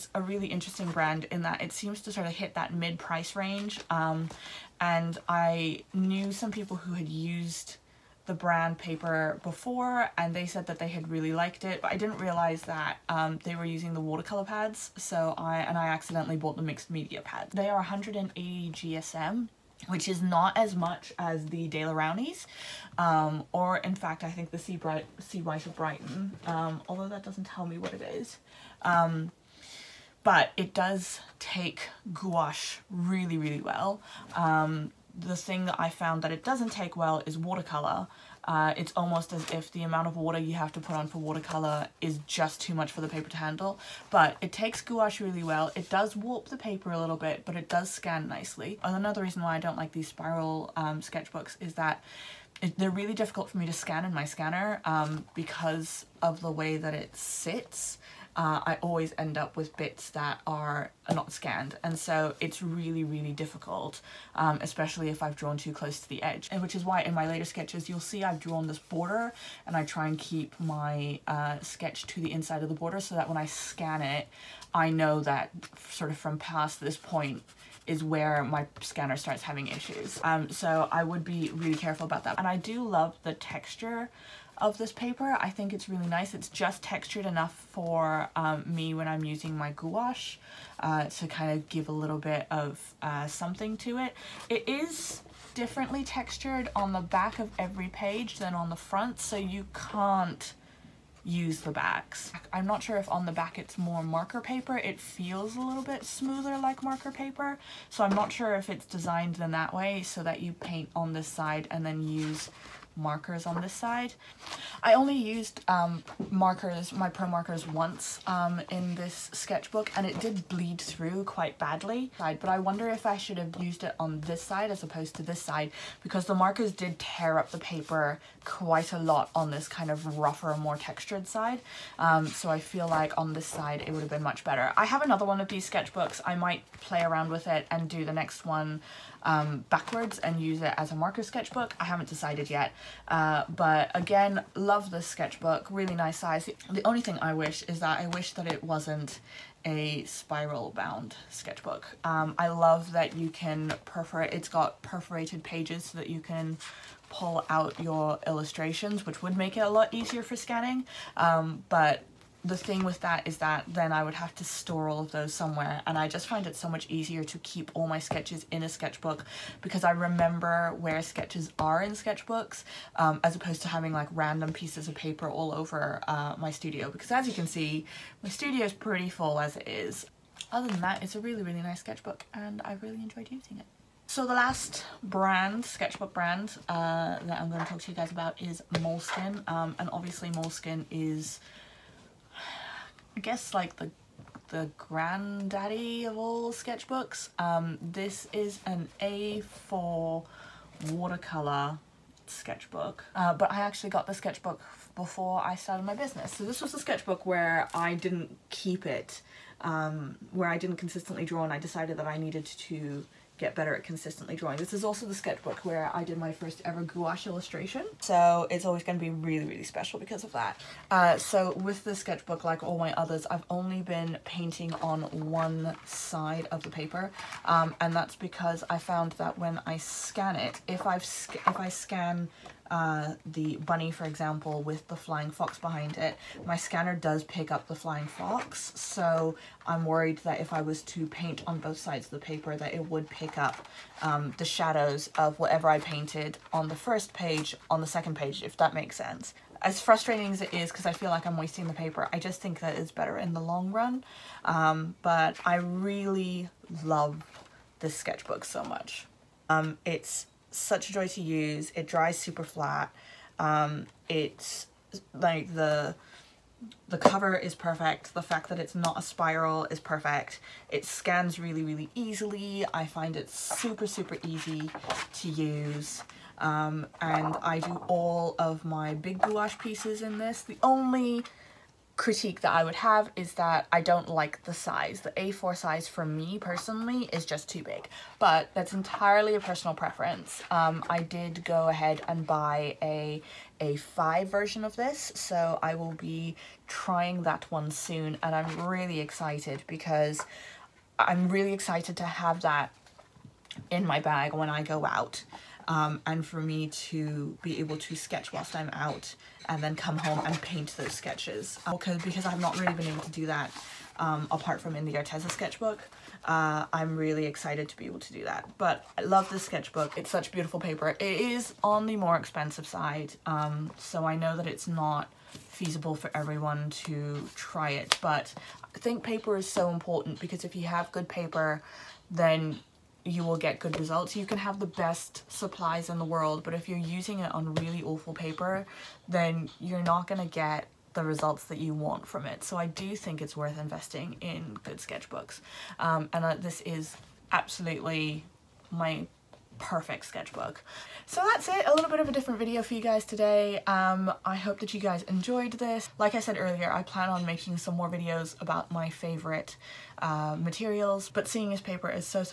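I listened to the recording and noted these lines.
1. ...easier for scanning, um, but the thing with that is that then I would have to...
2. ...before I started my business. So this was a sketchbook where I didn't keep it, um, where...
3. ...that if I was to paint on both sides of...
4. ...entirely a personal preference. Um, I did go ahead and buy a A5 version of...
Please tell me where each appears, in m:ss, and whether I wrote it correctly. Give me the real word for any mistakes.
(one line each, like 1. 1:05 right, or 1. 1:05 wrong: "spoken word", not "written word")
1. 2:39 right
2. 3:24 right
3. 4:00 right
4. 4:48 right.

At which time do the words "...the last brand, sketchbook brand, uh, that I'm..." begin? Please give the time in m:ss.
3:04.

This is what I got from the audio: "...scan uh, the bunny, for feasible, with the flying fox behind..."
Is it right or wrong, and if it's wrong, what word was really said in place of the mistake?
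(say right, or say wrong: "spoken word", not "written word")
wrong: "example", not "feasible".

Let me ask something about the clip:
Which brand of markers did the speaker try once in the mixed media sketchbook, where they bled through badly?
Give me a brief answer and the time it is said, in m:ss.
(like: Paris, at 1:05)
Pro markers, at 1:57.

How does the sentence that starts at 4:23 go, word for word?
Um, it's like the the cover is perfect.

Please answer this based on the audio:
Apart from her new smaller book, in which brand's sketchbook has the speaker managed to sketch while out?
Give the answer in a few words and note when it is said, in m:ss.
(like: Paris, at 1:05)
Arteza, at 5:14.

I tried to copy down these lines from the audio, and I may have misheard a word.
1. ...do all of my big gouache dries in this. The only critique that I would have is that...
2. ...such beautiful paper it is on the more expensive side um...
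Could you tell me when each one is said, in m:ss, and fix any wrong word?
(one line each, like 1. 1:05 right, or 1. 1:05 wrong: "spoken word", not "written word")
1. 4:37 wrong: "pieces", not "dries"
2. 5:20 right.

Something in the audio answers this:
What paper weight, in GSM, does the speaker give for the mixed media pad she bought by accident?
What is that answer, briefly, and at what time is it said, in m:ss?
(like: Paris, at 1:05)
180 GSM, at 0:17.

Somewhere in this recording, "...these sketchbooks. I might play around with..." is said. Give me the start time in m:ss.
2:15.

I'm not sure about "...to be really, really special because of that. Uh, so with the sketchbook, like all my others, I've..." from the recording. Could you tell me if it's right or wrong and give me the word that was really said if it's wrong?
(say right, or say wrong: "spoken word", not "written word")
right.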